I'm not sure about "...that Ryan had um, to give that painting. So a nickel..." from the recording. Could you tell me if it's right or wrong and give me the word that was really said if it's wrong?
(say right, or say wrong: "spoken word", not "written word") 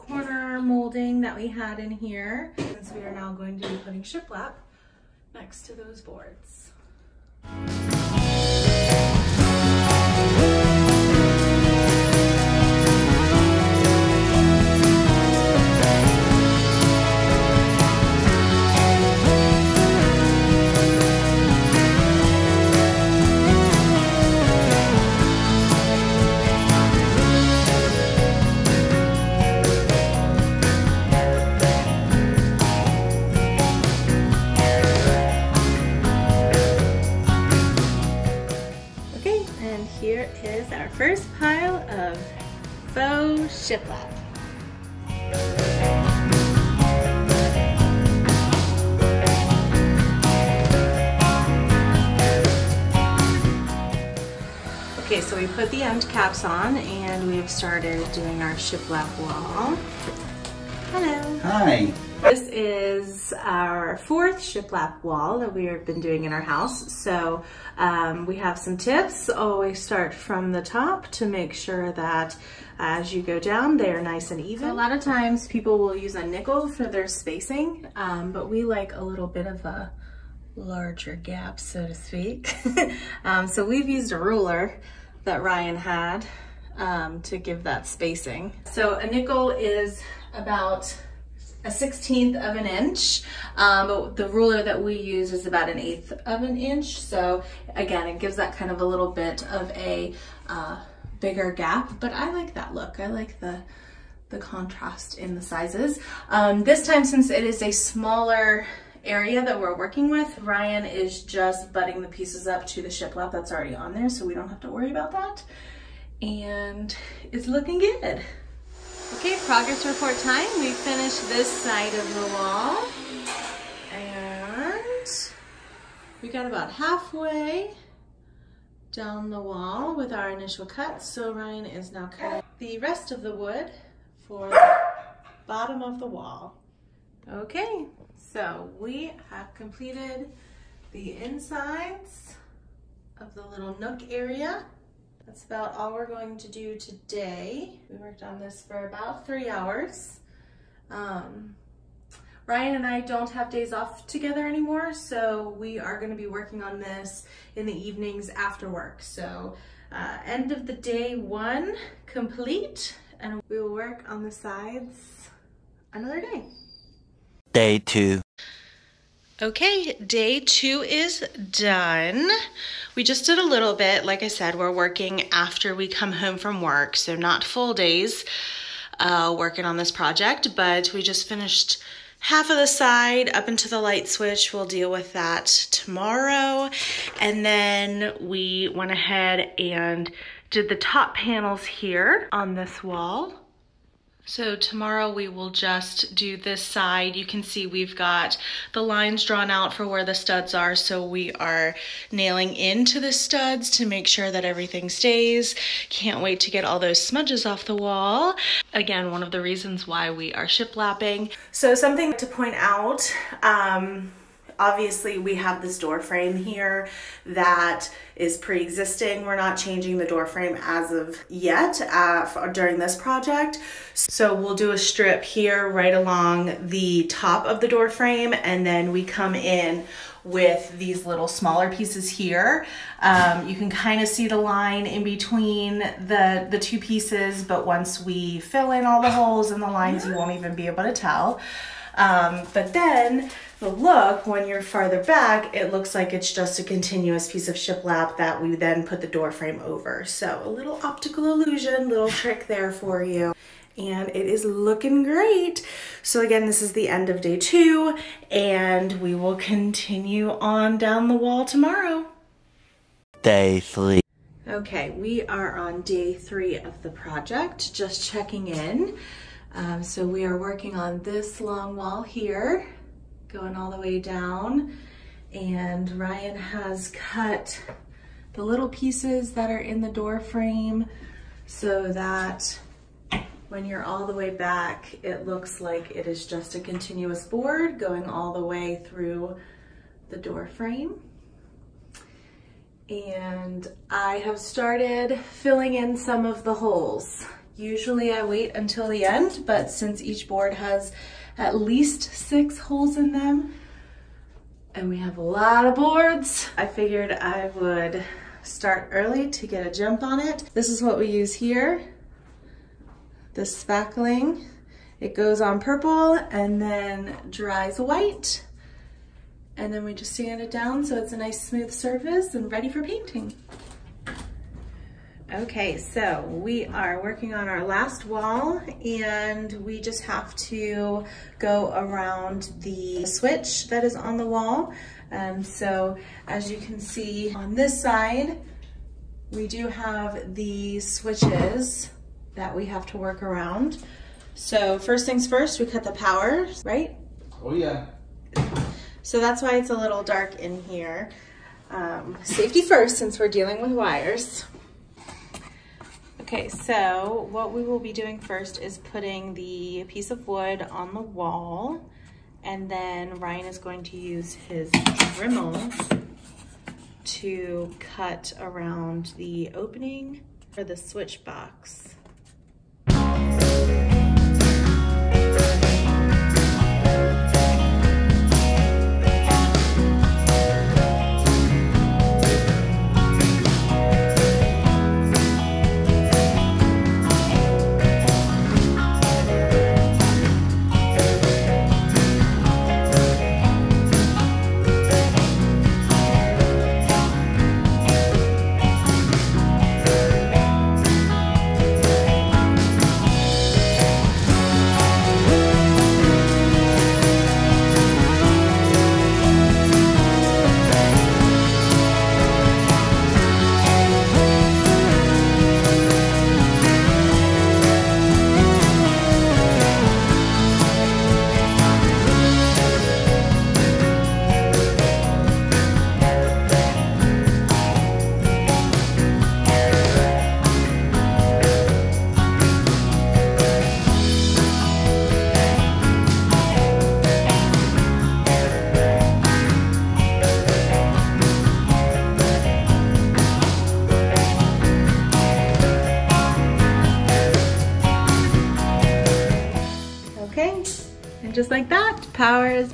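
wrong: "spacing", not "painting".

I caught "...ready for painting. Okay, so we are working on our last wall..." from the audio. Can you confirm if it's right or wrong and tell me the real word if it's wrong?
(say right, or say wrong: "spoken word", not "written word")
right.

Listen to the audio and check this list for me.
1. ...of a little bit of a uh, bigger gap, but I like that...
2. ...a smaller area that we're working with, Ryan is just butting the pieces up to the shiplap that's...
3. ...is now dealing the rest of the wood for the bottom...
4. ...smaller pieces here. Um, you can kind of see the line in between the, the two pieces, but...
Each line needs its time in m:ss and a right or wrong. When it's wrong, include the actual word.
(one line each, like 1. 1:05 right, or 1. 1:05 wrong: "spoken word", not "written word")
1. 1:38 right
2. 1:47 right
3. 2:11 wrong: "cutting", not "dealing"
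4. 3:51 right.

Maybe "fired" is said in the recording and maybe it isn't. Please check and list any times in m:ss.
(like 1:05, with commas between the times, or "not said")
not said.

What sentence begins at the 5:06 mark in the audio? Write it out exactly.
I figured I would start early to get a jump on it.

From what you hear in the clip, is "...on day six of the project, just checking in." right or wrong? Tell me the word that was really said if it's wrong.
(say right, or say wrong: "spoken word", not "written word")
wrong: "three", not "six".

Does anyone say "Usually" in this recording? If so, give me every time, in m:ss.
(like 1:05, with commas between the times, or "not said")
4:57.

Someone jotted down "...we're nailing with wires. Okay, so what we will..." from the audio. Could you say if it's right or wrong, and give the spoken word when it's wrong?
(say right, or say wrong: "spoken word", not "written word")
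wrong: "dealing", not "nailing".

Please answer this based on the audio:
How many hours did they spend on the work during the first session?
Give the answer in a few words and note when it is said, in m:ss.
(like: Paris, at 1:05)
3, at 2:29.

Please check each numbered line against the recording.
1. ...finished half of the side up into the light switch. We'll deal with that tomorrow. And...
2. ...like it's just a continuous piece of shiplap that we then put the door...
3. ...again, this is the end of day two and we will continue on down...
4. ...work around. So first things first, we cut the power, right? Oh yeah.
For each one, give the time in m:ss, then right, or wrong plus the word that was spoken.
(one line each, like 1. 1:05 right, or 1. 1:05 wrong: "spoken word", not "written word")
1. 3:01 right
2. 4:05 right
3. 4:16 right
4. 5:42 right.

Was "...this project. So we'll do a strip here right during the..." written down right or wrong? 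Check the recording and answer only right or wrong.
wrong.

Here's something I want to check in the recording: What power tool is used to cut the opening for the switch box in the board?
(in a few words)
Dremel.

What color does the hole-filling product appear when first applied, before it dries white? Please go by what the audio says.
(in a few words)
Purple.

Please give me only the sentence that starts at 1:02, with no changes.
This is our fourth shiplap wall that we have been doing in our house.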